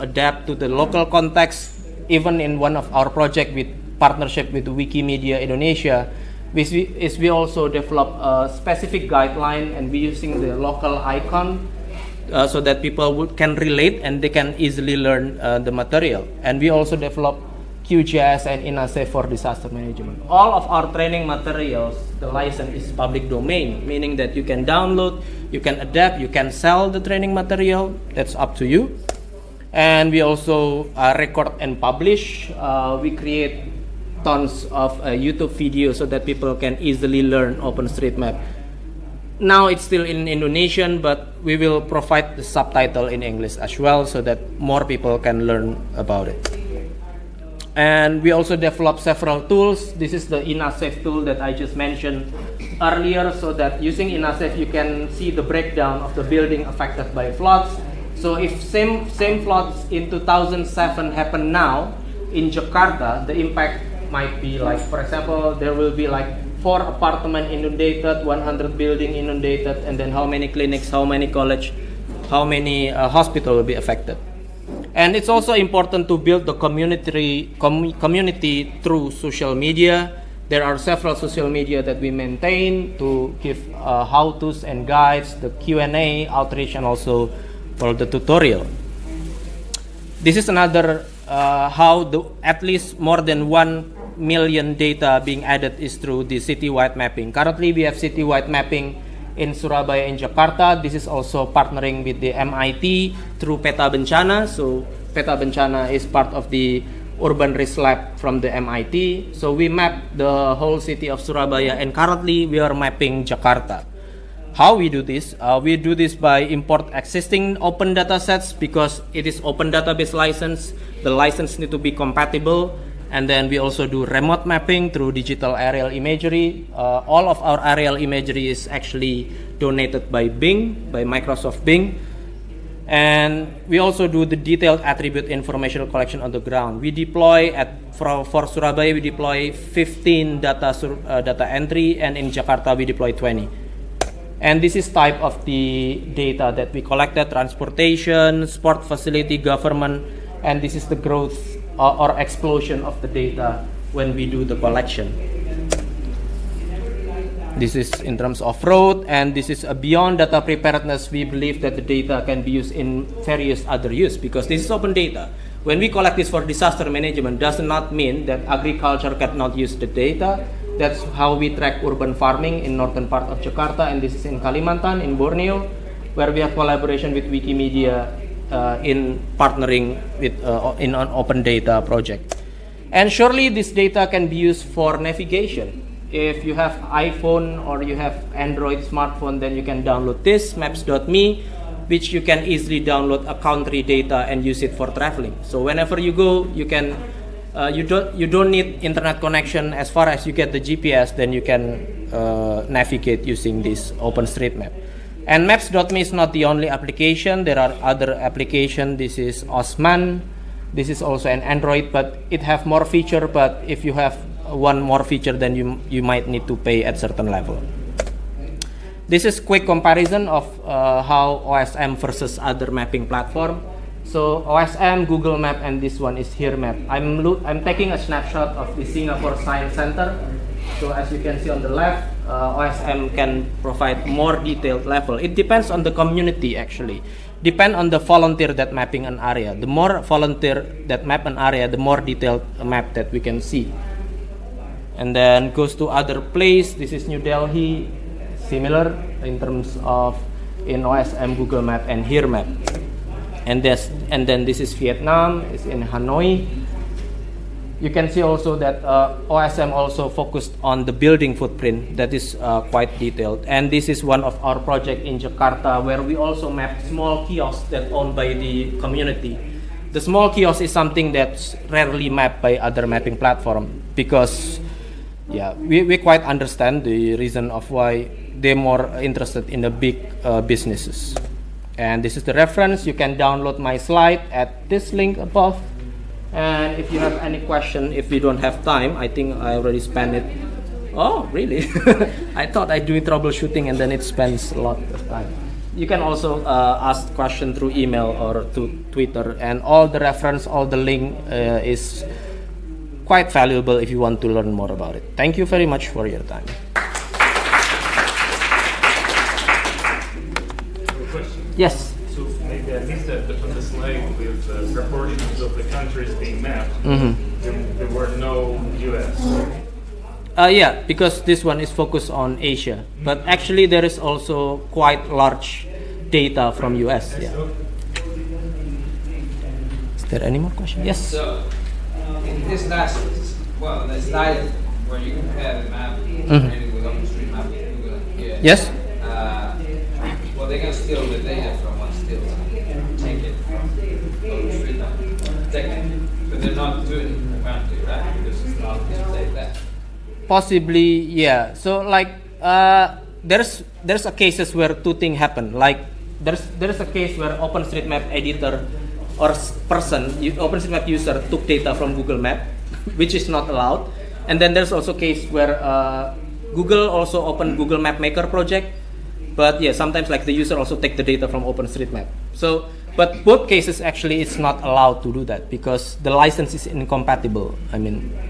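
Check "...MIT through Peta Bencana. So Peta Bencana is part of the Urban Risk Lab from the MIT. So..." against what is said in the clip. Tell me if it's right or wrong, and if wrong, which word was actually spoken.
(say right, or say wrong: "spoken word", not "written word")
right.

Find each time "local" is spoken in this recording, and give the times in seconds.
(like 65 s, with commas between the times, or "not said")
0 s, 10 s.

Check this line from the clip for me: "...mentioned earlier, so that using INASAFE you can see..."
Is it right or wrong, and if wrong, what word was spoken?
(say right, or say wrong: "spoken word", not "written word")
right.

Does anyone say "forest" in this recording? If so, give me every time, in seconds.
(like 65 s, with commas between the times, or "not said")
not said.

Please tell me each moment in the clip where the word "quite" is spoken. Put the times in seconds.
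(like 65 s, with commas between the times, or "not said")
262 s, 275 s, 303 s, 324 s.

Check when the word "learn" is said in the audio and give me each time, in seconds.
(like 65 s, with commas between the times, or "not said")
14 s, 37 s, 45 s, 304 s.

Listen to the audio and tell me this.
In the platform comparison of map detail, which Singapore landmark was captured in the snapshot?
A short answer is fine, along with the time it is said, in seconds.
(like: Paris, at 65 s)
Singapore Science Center, at 228 s.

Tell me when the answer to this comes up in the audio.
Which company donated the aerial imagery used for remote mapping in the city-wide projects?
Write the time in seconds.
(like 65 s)
131 s.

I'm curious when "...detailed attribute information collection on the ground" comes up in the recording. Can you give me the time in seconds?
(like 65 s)
134 s.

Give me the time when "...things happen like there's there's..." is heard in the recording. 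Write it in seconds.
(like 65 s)
354 s.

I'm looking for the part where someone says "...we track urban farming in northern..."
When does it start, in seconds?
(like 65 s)
171 s.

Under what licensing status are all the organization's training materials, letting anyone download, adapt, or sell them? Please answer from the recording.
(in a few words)
Public domain.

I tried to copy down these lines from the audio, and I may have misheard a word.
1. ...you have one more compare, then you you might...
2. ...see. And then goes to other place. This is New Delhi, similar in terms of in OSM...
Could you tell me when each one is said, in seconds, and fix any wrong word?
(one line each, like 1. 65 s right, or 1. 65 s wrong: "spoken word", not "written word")
1. 213 s wrong: "feature", not "compare"
2. 243 s right.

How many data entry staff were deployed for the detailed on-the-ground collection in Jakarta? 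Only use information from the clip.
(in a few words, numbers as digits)
20.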